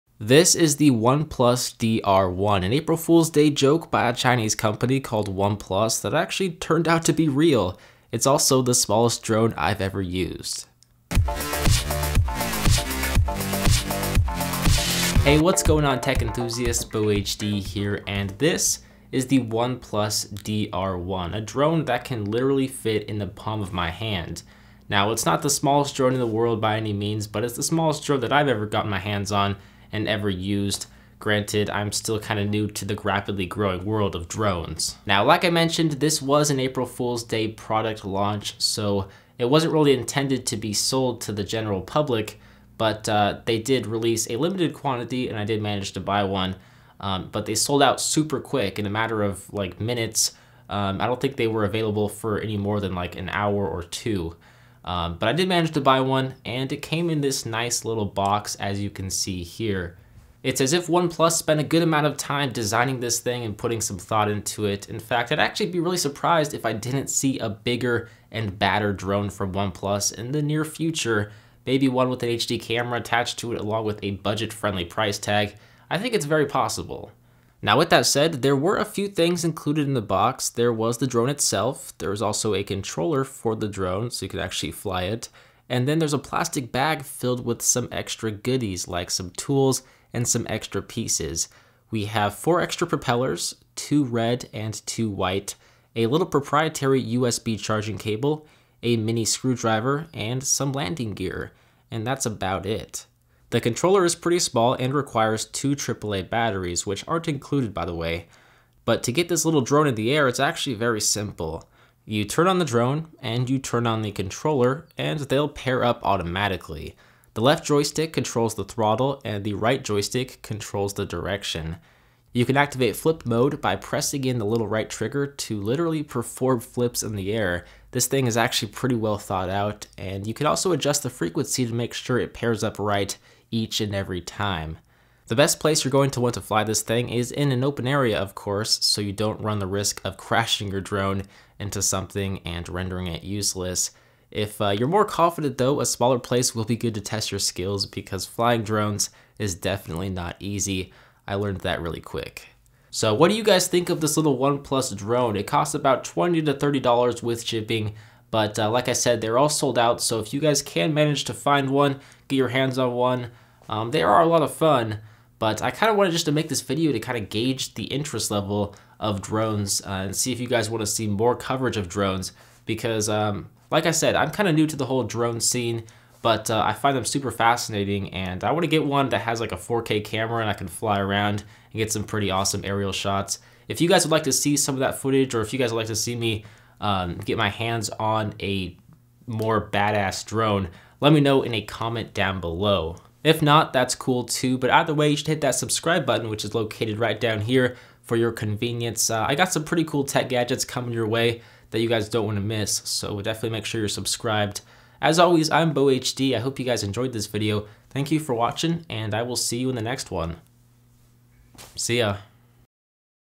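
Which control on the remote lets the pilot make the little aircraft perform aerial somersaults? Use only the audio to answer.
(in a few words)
right trigger.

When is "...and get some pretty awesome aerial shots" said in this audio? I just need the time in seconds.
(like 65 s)
181 s.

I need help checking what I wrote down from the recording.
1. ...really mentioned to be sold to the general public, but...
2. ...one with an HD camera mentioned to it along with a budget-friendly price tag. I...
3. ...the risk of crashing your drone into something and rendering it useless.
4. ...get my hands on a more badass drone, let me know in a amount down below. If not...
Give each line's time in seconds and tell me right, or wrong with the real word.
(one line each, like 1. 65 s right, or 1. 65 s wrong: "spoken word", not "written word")
1. 39 s wrong: "intended", not "mentioned"
2. 71 s wrong: "attached", not "mentioned"
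3. 139 s right
4. 187 s wrong: "comment", not "amount".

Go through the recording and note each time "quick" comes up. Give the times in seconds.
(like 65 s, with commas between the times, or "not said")
48 s, 152 s.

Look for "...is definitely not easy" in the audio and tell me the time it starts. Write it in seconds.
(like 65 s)
149 s.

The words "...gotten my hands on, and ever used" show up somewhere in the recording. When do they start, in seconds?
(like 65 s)
28 s.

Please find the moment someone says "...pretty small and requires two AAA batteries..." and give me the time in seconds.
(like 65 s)
104 s.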